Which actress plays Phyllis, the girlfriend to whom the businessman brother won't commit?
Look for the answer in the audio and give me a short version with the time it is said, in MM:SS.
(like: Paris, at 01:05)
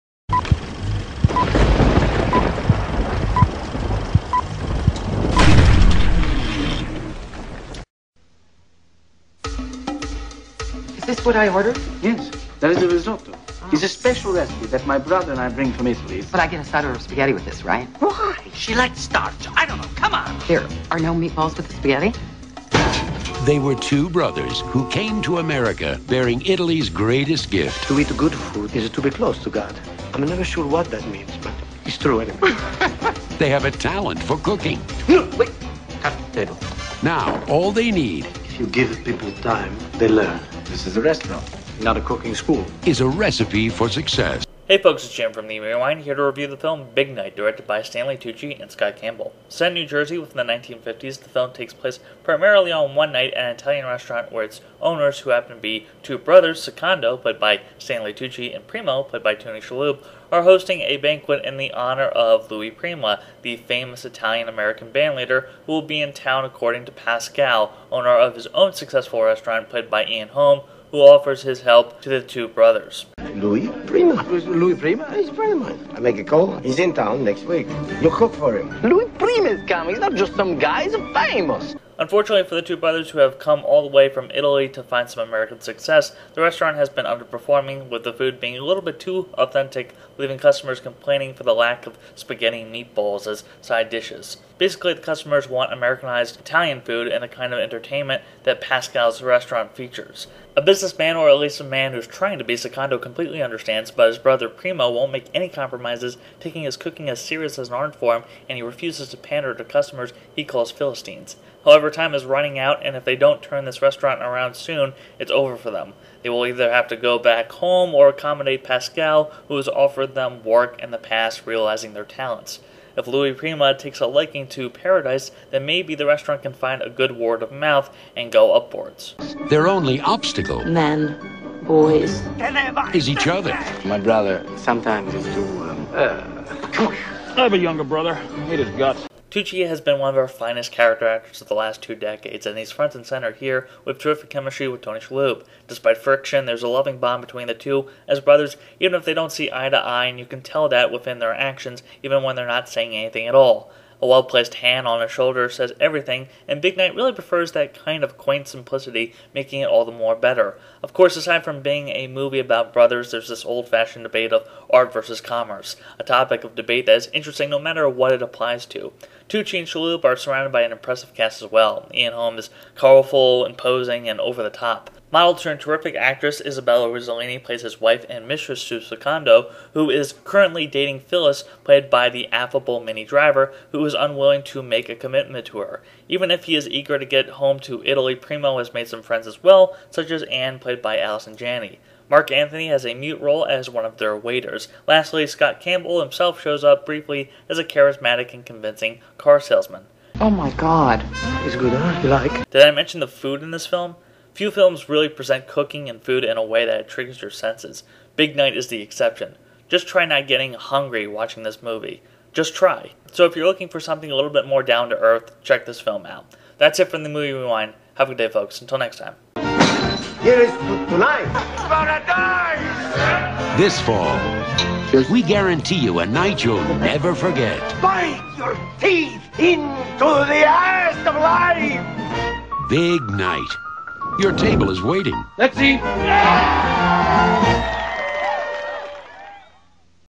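Minnie Driver, at 03:02.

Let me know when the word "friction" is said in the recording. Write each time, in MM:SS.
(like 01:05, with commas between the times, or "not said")
02:25.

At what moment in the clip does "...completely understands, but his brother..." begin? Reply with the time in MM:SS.
01:42.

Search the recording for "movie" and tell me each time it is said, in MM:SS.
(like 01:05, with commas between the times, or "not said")
02:42, 03:31, 03:37.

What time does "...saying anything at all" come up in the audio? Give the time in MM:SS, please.
02:32.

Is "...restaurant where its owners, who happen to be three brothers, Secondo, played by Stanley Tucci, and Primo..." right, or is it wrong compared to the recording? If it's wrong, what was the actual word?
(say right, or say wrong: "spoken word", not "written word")
wrong: "two", not "three".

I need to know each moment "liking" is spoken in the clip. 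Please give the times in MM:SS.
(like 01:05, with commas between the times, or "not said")
02:04.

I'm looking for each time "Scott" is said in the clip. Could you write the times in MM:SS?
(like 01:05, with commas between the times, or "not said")
00:48, 03:15.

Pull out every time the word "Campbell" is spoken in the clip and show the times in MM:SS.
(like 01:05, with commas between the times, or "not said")
00:48, 03:15.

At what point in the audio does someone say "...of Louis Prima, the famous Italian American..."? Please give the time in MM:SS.
01:02.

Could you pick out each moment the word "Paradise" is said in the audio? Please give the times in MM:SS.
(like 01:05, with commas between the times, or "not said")
02:04.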